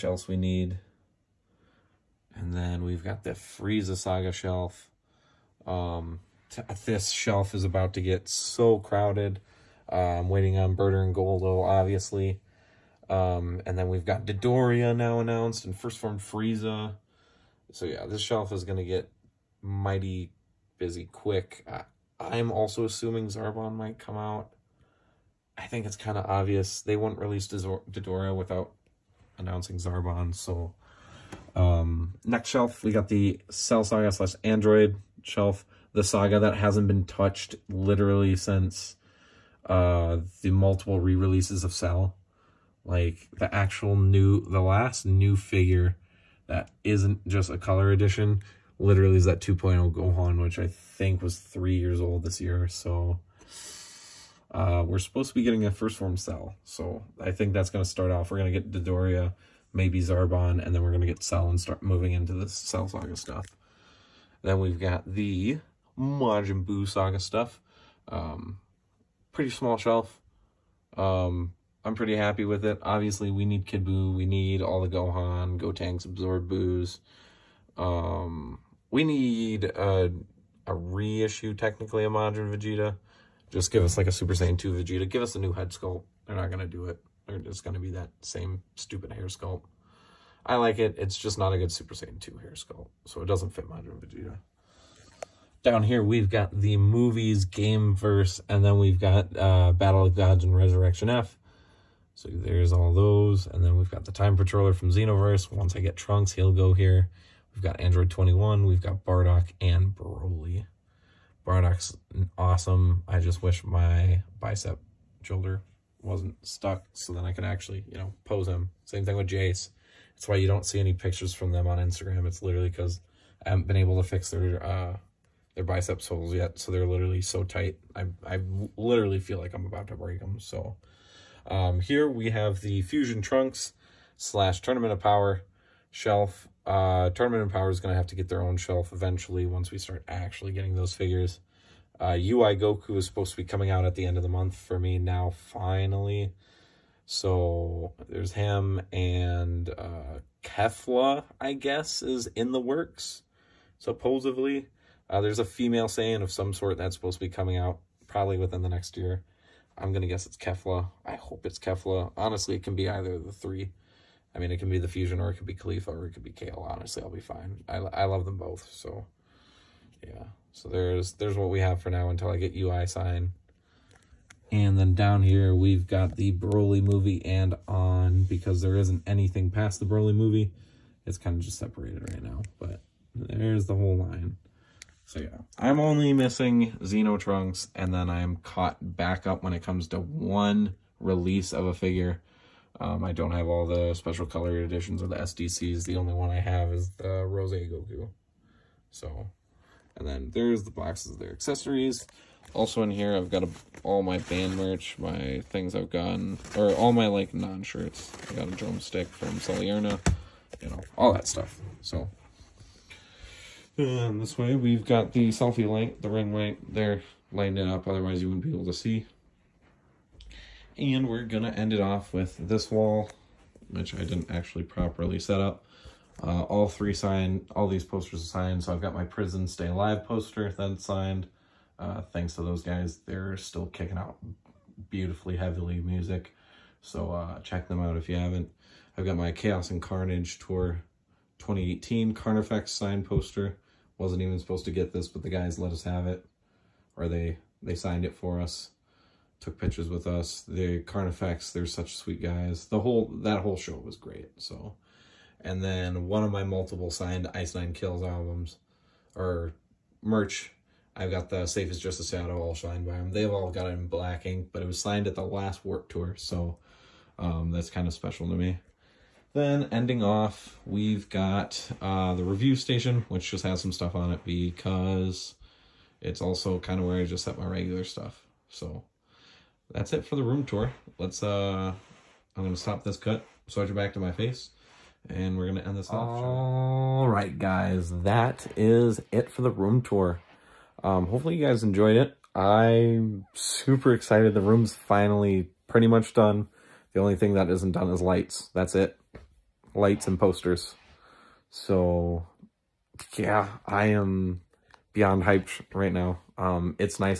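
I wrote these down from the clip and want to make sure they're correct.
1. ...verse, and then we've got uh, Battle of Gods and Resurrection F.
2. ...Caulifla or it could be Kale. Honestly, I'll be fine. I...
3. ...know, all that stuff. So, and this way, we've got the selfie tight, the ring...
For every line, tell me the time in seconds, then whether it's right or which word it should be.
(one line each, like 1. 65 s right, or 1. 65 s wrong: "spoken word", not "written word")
1. 97 s right
2. 165 s right
3. 210 s wrong: "light", not "tight".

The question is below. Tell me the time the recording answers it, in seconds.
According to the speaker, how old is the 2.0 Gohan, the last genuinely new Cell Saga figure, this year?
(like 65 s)
51 s.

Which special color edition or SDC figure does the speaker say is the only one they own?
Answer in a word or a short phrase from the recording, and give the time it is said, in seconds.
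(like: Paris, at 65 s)
Rose Goku, at 197 s.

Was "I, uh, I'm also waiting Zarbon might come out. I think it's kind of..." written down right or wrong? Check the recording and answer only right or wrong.
wrong.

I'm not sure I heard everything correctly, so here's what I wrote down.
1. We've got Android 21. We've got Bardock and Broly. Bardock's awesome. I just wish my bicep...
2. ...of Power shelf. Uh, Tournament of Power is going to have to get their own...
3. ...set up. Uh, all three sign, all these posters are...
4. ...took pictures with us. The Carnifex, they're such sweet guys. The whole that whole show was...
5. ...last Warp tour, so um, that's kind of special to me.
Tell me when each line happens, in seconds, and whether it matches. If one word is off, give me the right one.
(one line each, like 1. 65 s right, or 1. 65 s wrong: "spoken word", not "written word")
1. 107 s right
2. 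134 s right
3. 225 s right
4. 249 s right
5. 265 s right.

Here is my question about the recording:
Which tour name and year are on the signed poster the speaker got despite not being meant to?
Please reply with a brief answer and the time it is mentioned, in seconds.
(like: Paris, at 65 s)
Chaos and Carnage 2018, at 239 s.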